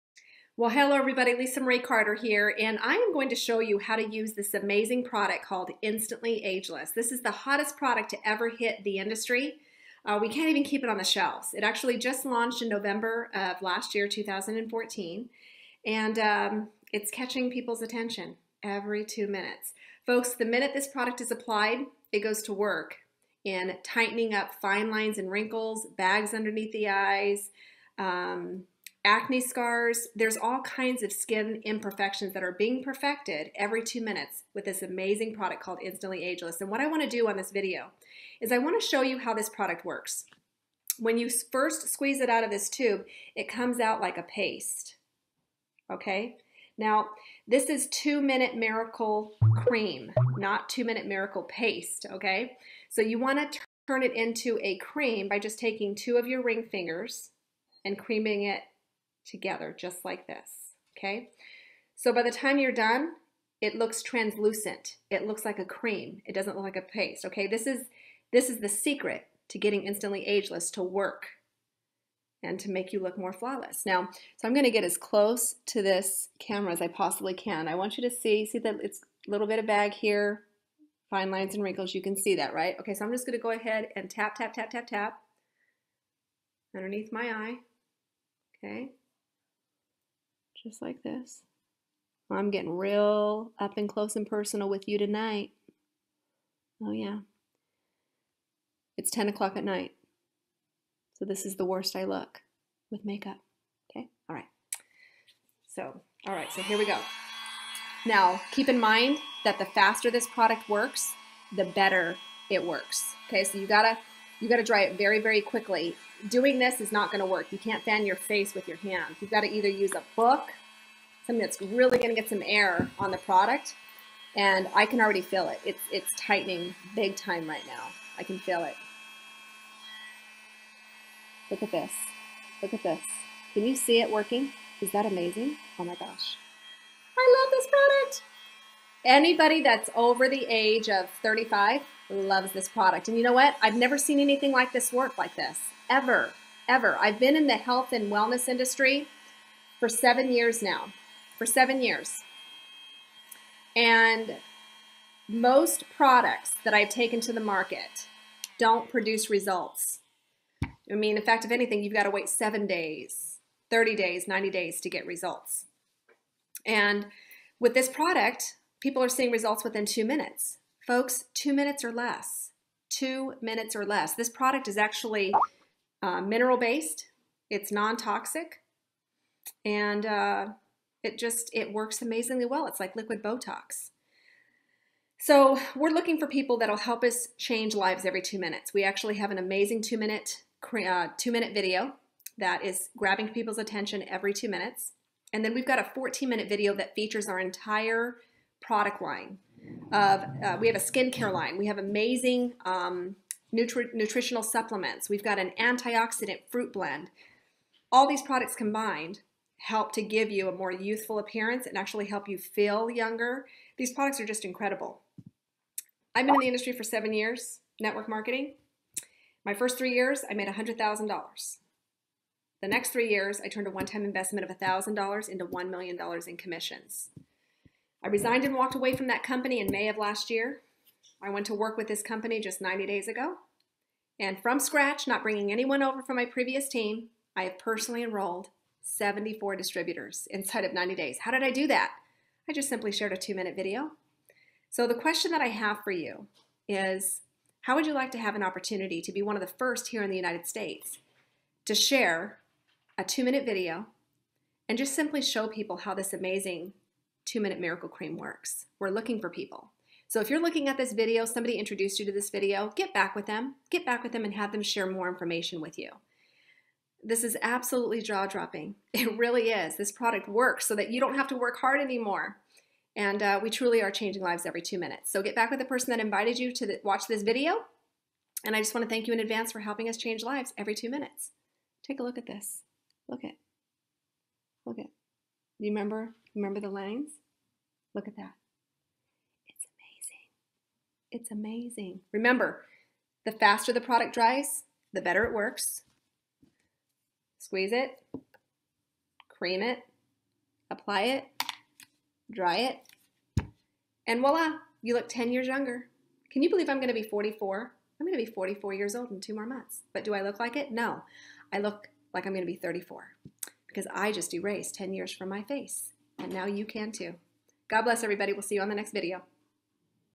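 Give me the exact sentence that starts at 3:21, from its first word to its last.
We have amazing um, nutri nutritional supplements.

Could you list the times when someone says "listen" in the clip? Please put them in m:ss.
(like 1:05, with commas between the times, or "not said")
not said.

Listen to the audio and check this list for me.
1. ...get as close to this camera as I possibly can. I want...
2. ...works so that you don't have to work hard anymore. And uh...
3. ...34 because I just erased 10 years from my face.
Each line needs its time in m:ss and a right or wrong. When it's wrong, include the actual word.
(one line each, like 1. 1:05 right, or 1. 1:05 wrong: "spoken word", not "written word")
1. 1:14 right
2. 4:30 right
3. 5:12 right.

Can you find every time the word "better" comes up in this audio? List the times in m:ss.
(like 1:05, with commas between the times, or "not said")
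1:51, 4:55.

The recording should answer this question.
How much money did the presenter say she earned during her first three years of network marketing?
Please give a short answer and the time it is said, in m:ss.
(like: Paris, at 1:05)
$100,000, at 3:40.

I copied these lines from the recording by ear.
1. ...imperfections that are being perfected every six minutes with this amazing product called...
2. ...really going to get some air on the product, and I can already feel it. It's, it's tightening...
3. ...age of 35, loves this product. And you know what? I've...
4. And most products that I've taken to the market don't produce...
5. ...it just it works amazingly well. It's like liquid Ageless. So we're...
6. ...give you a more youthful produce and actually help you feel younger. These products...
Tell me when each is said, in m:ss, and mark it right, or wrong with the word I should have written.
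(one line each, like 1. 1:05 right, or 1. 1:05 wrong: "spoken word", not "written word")
1. 0:31 wrong: "two", not "six"
2. 2:01 right
3. 2:20 right
4. 2:33 right
5. 3:01 wrong: "Botox", not "Ageless"
6. 3:30 wrong: "appearance", not "produce".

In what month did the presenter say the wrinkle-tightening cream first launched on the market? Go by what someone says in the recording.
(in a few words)
November.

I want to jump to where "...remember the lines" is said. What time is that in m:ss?
4:46.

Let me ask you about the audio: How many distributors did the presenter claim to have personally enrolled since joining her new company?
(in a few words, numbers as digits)
74.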